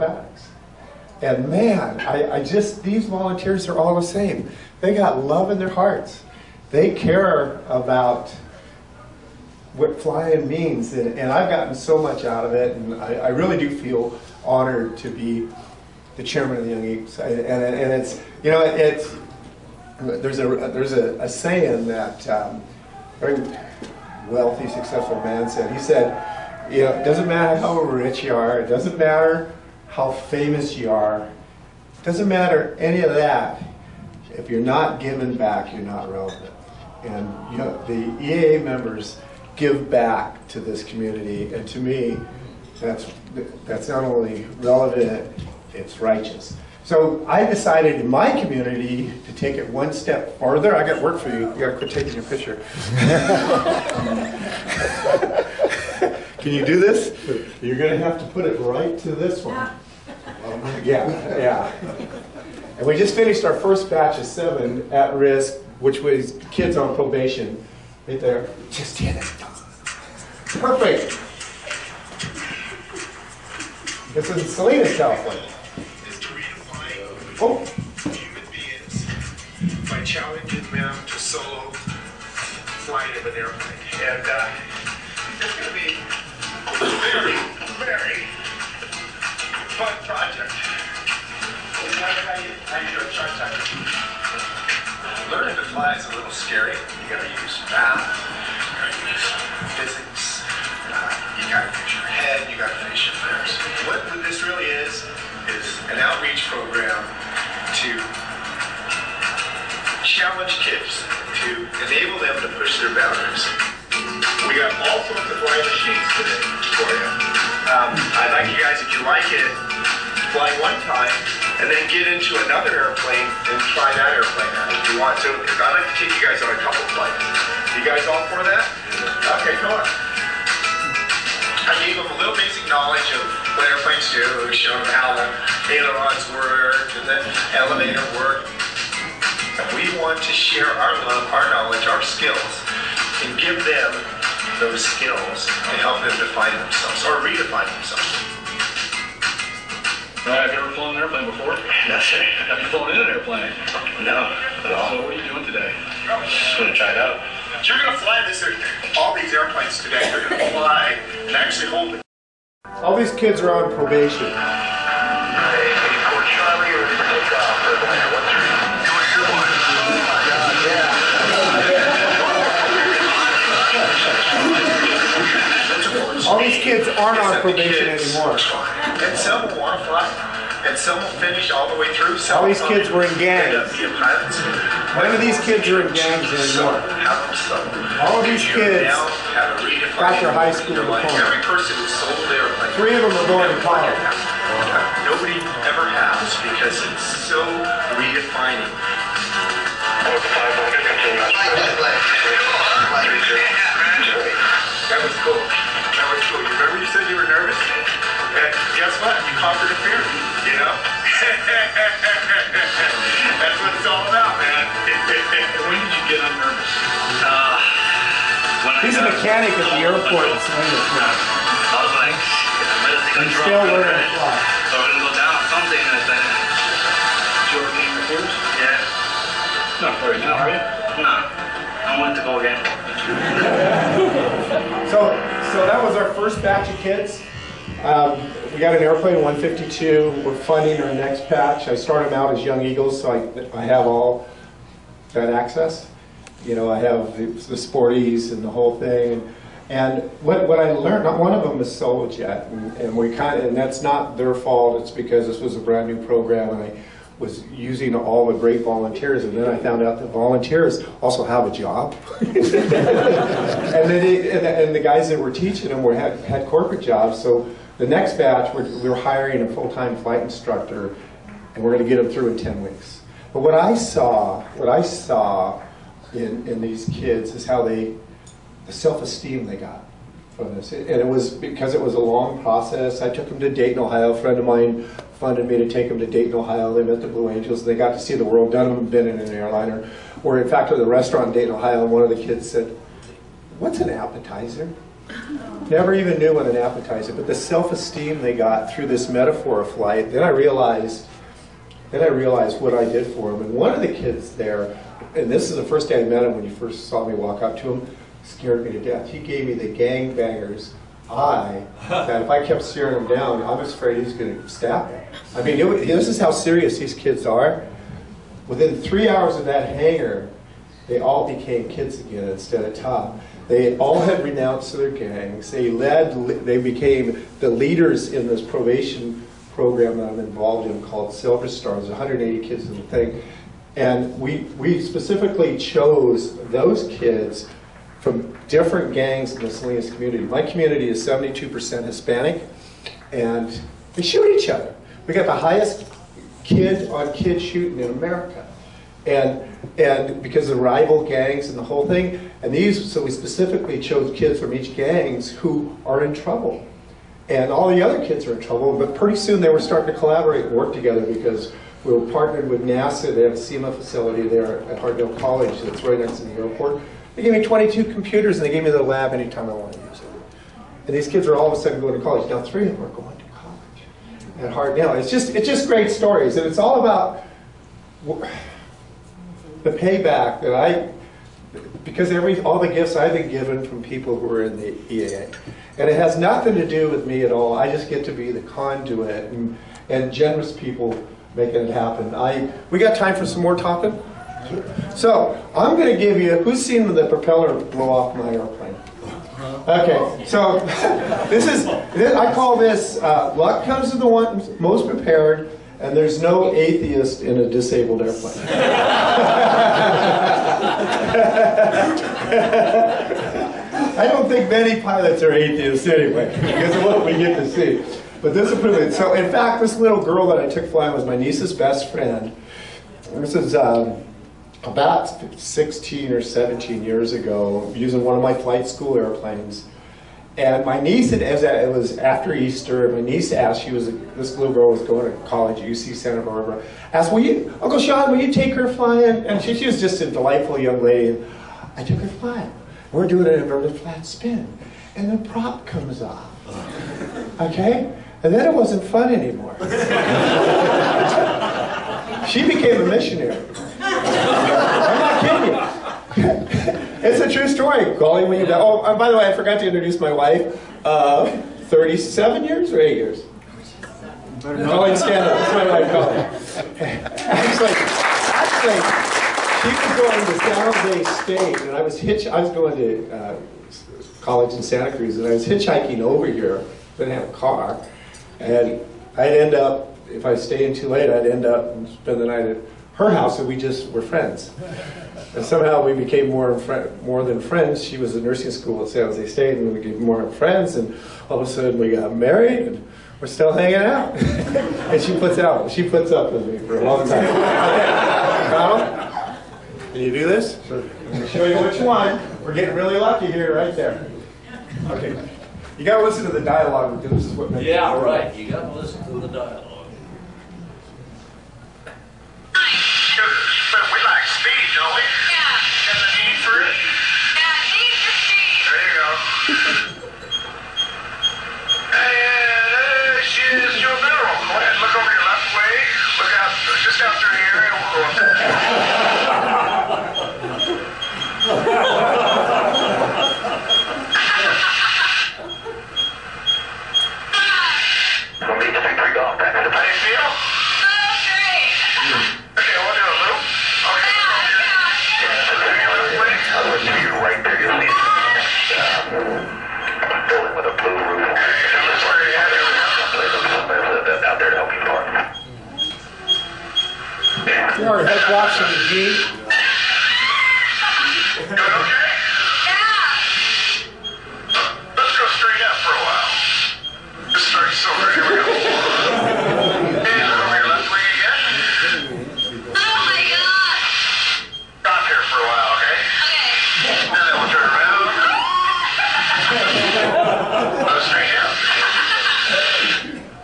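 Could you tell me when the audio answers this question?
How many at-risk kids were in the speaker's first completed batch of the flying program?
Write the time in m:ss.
1:04.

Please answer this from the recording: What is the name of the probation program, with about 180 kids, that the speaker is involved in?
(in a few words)
Silver Stars.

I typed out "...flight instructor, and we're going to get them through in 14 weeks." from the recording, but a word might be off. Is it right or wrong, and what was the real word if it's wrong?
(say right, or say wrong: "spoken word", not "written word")
wrong: "10", not "14".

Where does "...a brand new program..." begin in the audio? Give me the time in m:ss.
4:15.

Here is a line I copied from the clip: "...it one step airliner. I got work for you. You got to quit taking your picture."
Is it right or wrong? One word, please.
wrong.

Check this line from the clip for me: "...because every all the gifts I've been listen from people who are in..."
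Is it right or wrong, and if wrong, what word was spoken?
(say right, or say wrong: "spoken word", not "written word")
wrong: "given", not "listen".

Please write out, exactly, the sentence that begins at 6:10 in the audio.
And these kids are all of a sudden going to college.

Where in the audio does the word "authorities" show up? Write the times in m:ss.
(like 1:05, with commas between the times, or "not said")
not said.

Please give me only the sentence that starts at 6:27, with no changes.
I just get to be the conduit and, and generous people making it happen.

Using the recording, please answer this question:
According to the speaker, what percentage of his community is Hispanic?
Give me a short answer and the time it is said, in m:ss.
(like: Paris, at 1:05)
72%, at 5:41.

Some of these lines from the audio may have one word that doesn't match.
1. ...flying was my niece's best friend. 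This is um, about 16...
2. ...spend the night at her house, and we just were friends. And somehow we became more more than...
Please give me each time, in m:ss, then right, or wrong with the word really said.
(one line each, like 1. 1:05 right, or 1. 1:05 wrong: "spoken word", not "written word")
1. 7:00 right
2. 8:01 right.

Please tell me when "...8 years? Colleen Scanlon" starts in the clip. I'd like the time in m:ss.
7:42.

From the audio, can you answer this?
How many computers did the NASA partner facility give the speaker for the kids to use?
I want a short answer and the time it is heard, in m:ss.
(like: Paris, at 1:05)
22, at 6:07.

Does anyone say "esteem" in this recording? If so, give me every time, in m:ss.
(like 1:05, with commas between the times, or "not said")
4:38, 4:57.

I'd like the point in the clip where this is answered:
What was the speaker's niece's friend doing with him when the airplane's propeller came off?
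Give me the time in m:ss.
7:23.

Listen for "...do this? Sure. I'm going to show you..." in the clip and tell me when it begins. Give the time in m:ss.
8:20.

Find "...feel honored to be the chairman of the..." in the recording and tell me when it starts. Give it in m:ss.
0:13.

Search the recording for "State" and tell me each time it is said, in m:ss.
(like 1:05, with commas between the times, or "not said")
7:51, 8:09.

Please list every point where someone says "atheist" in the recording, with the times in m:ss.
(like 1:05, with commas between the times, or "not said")
6:46, 6:55.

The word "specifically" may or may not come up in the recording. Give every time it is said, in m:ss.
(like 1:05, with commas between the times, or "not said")
5:34, 5:53.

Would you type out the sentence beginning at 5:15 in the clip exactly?
I mean, it, this is how serious these kids are.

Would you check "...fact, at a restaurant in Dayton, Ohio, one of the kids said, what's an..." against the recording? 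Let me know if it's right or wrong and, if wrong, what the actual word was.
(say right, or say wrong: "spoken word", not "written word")
right.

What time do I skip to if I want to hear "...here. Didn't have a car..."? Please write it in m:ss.
7:56.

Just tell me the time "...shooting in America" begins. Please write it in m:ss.
5:47.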